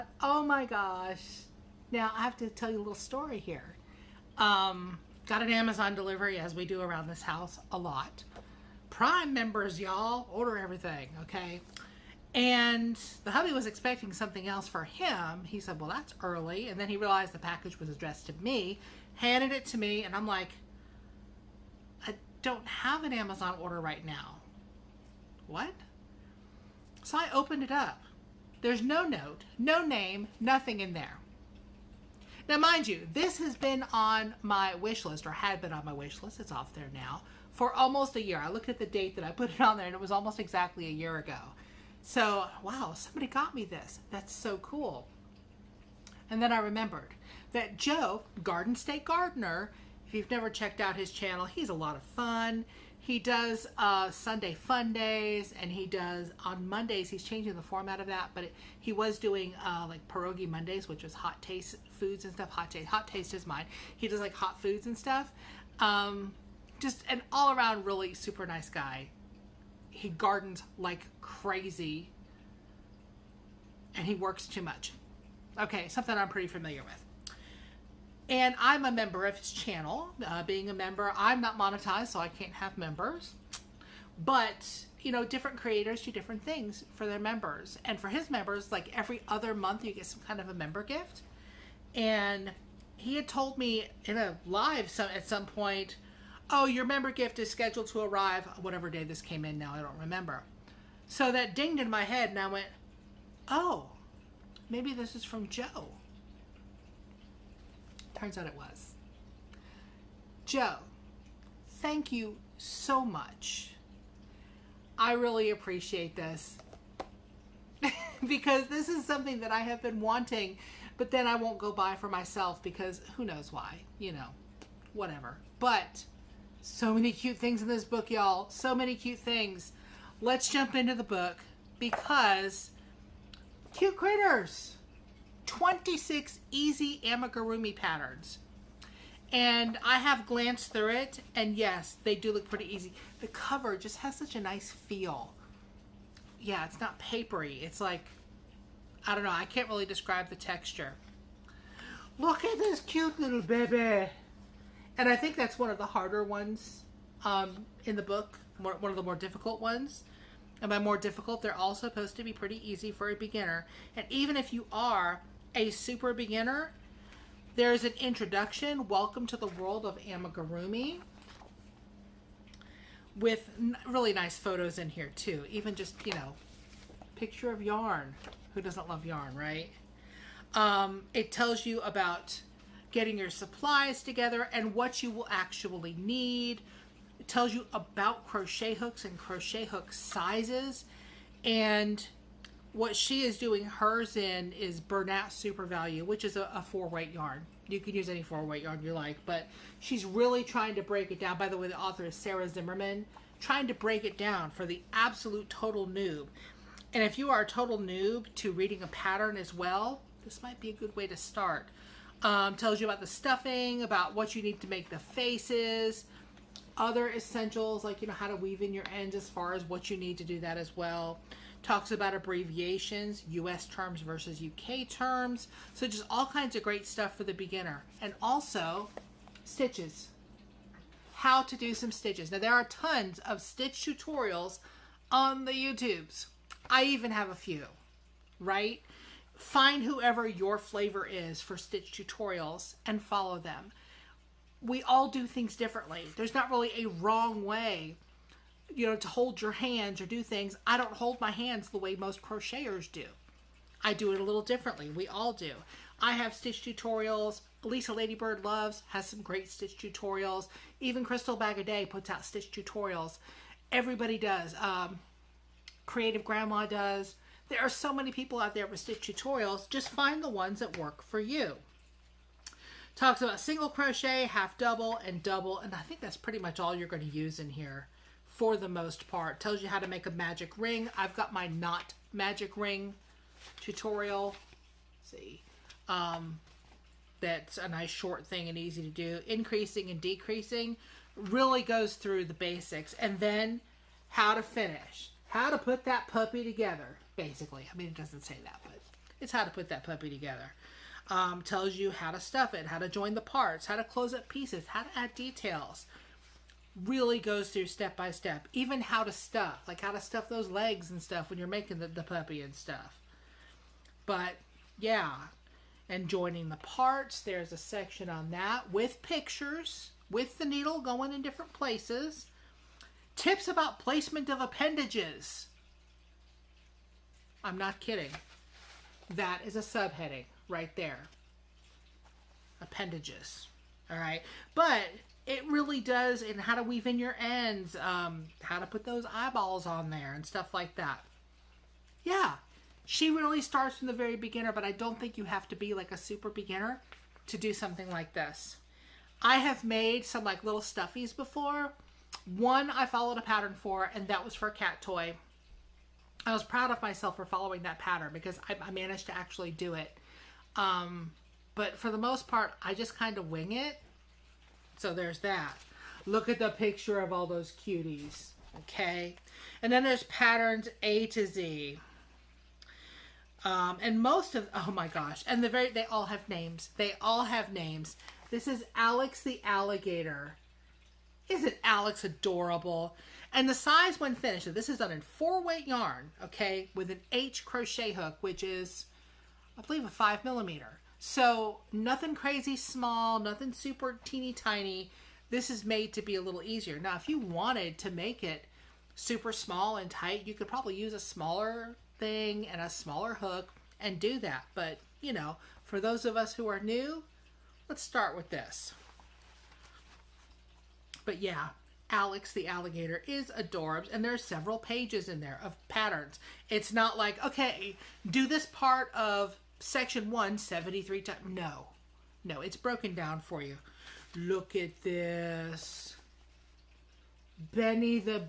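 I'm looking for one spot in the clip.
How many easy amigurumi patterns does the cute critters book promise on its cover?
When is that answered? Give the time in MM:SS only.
02:15.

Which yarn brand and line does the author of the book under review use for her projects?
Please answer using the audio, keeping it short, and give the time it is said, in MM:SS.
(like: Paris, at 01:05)
Bernat Super Value, at 03:14.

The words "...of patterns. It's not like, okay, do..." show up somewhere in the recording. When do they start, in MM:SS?
06:55.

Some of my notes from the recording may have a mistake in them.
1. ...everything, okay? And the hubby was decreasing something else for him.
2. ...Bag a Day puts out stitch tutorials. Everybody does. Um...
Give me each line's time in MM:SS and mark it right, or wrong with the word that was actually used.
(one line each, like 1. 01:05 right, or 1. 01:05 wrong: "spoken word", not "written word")
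1. 00:10 wrong: "expecting", not "decreasing"
2. 04:21 right.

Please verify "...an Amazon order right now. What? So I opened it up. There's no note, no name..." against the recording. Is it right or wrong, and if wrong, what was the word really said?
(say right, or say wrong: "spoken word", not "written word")
right.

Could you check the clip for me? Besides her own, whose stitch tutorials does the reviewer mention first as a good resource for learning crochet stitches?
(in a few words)
Lisa Ladybird Loves.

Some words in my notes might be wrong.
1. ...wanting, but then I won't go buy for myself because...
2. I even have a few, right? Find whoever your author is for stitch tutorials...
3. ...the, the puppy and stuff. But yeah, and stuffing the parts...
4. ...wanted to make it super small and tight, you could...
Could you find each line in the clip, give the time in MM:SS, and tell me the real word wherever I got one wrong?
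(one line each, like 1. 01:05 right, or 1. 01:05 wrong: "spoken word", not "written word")
1. 02:00 right
2. 03:56 wrong: "flavor", not "author"
3. 05:11 wrong: "joining", not "stuffing"
4. 06:37 right.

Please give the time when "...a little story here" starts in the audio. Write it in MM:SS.
00:02.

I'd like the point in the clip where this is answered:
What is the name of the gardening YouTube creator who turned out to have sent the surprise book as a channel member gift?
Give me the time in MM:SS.
00:48.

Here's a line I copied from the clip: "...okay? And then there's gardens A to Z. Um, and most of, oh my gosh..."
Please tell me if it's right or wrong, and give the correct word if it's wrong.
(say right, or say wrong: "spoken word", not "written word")
wrong: "patterns", not "gardens".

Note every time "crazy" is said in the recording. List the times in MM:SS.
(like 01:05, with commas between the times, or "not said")
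01:11, 06:32.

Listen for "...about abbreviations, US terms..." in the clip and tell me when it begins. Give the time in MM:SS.
03:41.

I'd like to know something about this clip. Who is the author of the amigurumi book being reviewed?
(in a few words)
Sarah Zimmerman.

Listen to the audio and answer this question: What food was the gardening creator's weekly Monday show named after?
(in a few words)
Pierogi.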